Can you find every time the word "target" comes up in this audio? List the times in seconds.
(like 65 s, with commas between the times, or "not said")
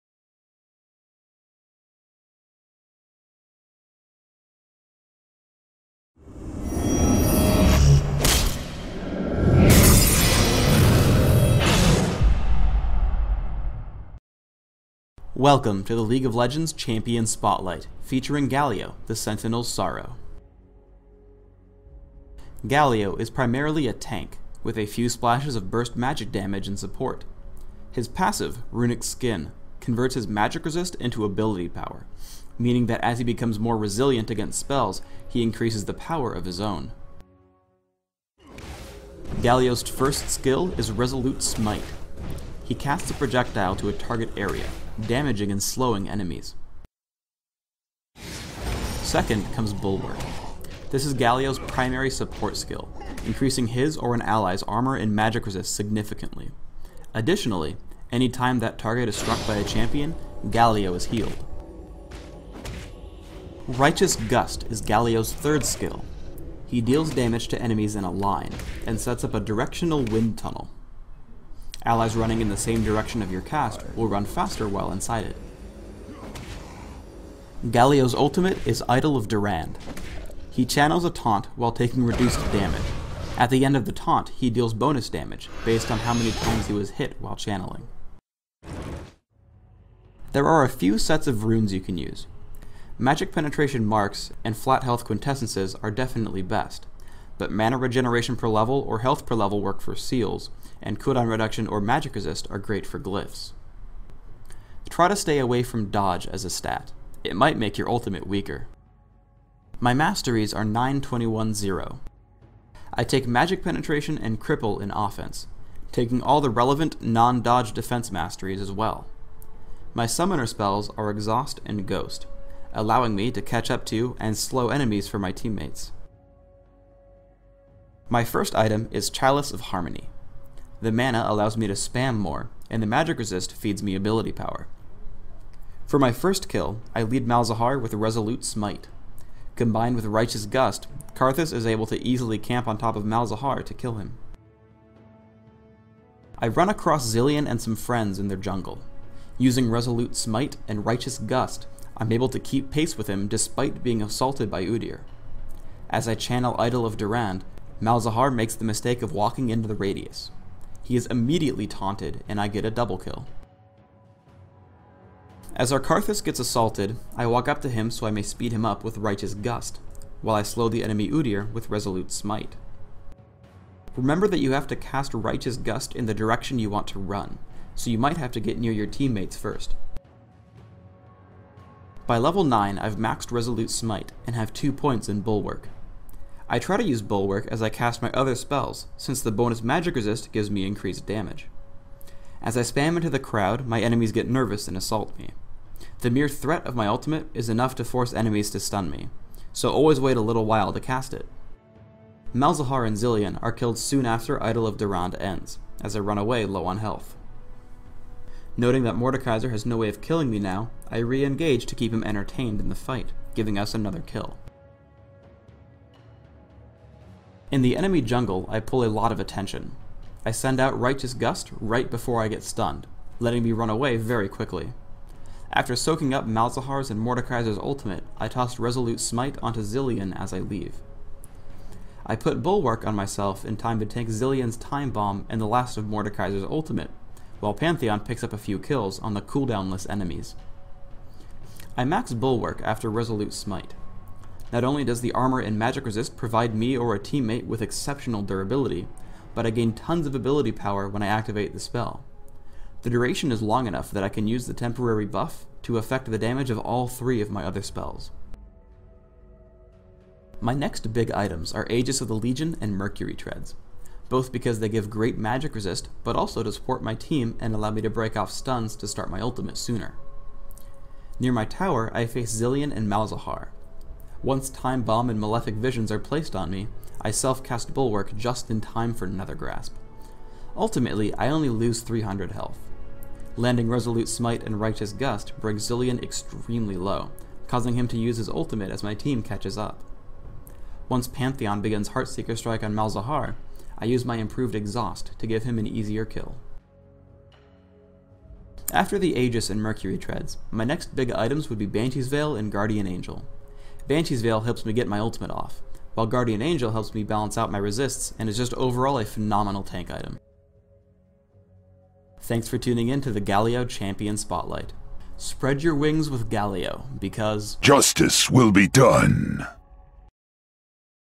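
43 s, 58 s.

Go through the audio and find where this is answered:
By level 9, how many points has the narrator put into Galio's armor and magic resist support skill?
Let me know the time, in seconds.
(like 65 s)
184 s.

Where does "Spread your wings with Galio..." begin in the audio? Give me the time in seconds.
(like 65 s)
315 s.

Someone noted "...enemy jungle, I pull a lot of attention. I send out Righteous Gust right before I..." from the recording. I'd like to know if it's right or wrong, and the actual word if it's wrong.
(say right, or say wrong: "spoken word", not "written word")
right.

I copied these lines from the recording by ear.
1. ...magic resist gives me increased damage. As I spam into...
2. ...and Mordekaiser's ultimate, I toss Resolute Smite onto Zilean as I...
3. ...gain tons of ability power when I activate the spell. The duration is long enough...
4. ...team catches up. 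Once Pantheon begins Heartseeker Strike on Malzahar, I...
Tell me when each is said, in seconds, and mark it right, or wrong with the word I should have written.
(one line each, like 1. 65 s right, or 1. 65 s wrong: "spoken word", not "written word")
1. 189 s right
2. 226 s right
3. 249 s right
4. 288 s right.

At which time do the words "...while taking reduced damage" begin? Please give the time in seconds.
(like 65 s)
81 s.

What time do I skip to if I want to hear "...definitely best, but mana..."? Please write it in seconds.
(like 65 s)
95 s.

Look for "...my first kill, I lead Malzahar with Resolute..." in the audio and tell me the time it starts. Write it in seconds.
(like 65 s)
135 s.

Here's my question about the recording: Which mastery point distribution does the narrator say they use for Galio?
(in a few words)
9210.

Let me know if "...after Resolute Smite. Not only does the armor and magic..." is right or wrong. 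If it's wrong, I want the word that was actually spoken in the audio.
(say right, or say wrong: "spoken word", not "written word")
right.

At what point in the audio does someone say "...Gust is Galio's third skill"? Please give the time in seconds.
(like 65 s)
64 s.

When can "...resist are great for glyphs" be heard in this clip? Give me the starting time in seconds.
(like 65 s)
102 s.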